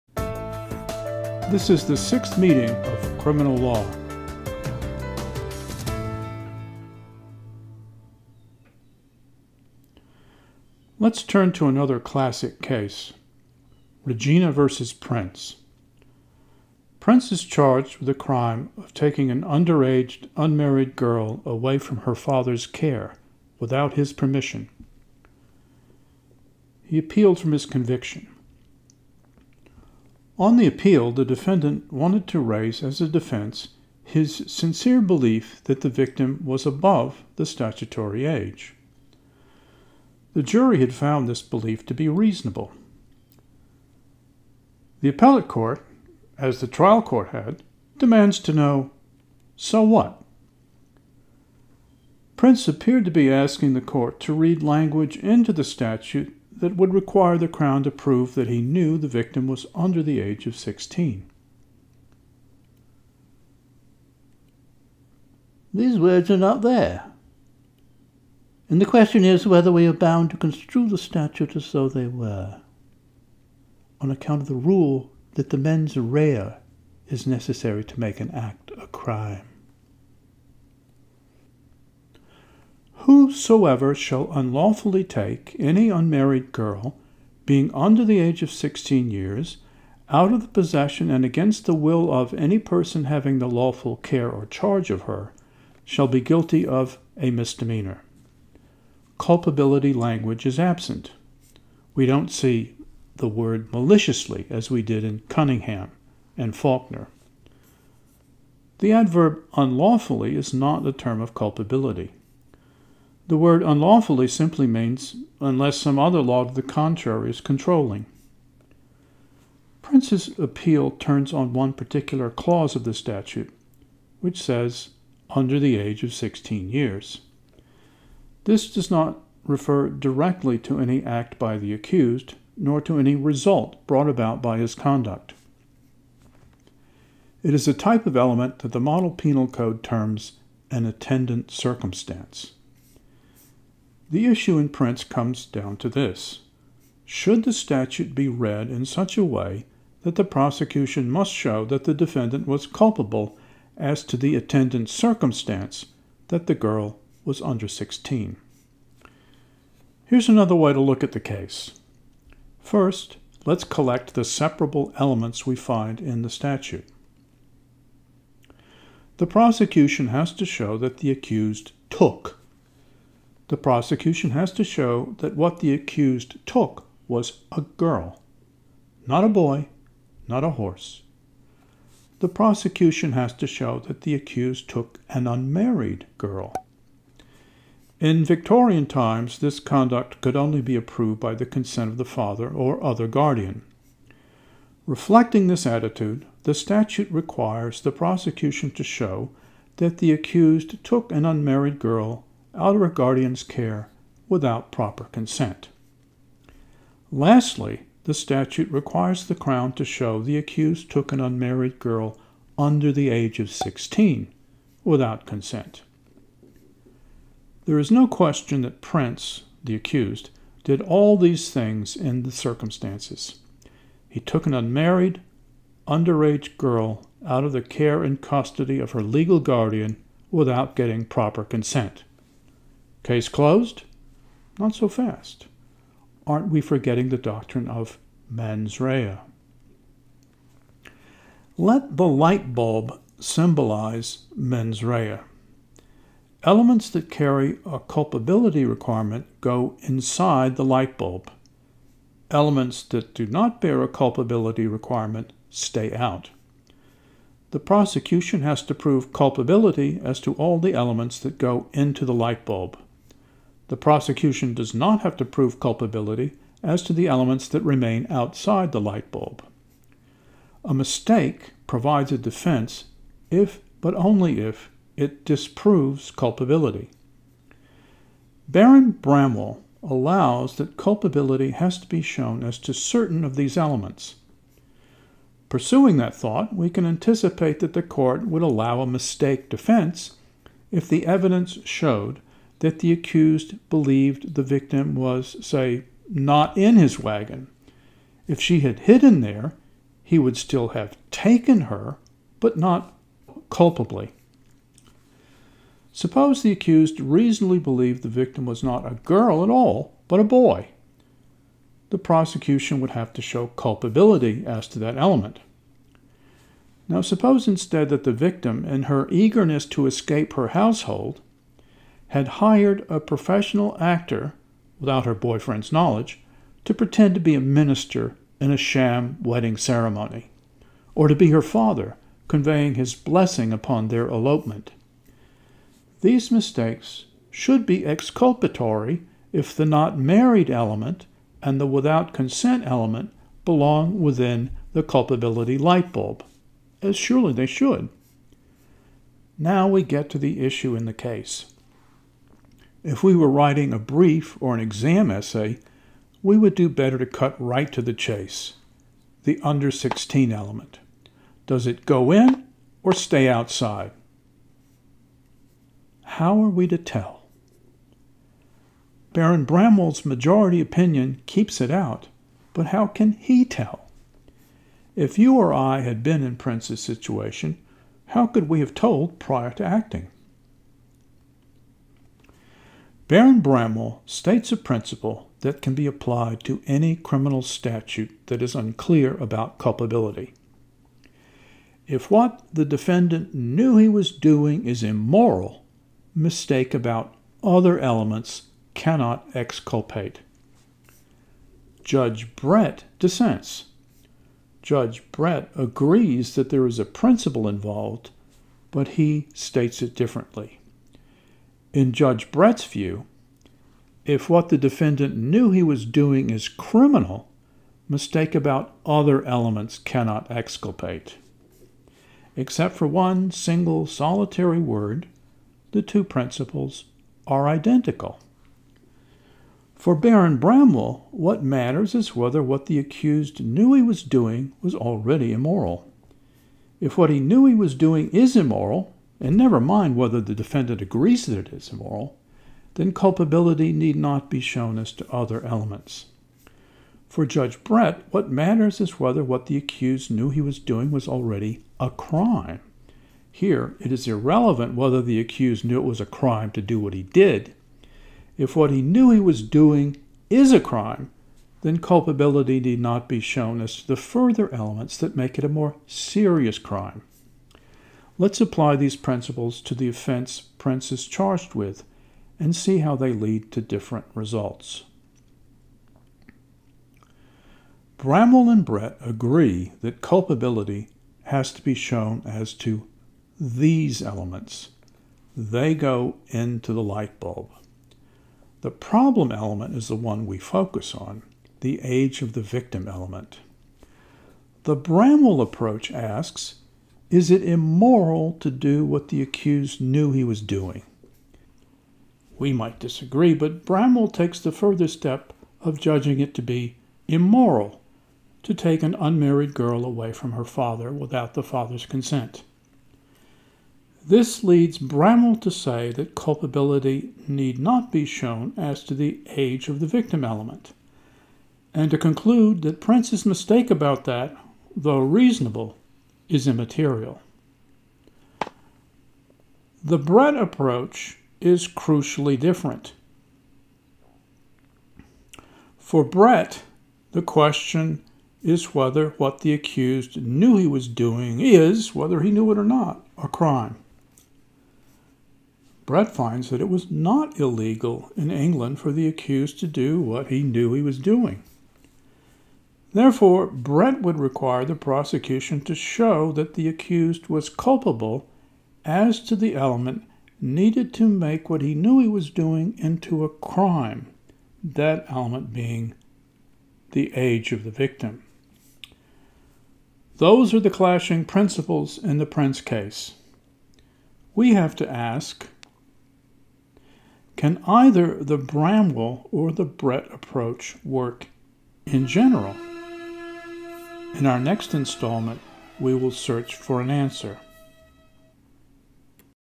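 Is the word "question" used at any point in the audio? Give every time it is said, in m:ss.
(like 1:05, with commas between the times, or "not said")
1:08, 3:38, 8:57.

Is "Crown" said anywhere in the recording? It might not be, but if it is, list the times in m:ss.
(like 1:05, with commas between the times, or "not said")
0:57, 3:29.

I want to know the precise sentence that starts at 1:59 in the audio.
Prince's appeal turns on one particular clause of the statute, which says under the age of 16 years.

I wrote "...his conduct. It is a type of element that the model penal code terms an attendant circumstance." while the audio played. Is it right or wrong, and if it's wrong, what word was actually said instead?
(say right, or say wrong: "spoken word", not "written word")
right.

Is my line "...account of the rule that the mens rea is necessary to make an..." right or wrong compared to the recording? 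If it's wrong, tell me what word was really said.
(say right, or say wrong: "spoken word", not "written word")
right.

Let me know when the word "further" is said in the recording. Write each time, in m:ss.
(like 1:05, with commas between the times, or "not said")
7:43, 8:24.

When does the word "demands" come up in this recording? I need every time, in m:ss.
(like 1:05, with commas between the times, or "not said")
0:47.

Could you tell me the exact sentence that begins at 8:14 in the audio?
The Bramwell approach asks is it immoral to do what the accused knew he was doing?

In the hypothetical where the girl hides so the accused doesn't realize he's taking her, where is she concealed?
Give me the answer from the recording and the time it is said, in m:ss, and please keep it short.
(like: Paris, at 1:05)
his wagon, at 4:56.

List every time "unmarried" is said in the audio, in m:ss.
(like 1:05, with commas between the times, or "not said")
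0:20, 1:25, 3:05, 3:21, 3:31, 3:44, 8:28.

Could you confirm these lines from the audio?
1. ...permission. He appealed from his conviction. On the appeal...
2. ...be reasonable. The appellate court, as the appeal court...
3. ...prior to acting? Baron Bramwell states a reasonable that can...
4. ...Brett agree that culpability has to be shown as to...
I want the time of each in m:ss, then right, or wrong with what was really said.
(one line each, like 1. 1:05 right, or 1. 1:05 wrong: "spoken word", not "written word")
1. 0:24 right
2. 0:41 wrong: "trial", not "appeal"
3. 6:19 wrong: "principle", not "reasonable"
4. 7:58 right.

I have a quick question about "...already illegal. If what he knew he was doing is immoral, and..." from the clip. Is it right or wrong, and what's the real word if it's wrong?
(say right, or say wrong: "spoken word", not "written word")
wrong: "immoral", not "illegal".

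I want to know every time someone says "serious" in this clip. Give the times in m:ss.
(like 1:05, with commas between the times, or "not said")
7:45.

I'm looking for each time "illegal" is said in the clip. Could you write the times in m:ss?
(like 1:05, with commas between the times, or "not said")
9:07.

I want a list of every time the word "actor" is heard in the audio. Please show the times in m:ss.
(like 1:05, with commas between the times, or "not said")
5:23.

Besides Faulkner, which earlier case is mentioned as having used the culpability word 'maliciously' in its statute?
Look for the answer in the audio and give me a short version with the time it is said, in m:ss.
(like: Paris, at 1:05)
Cunningham, at 1:45.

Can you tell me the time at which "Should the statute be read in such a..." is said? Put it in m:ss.
2:27.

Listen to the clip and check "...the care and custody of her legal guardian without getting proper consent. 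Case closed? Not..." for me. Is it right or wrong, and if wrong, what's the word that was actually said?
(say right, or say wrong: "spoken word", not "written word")
right.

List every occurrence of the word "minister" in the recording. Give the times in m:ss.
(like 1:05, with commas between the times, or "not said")
5:27.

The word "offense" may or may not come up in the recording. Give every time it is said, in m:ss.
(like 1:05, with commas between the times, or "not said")
7:49.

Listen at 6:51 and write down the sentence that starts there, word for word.
In Judge Brett's view, if what the defendant knew he was doing is criminal, mistake about other elements cannot exculpate.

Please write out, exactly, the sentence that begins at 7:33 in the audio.
Here, it is irrelevant whether the accused knew it was a crime to do what he did.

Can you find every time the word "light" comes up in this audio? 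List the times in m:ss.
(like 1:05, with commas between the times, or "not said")
4:02, 4:10, 4:22, 4:28, 5:45, 8:06.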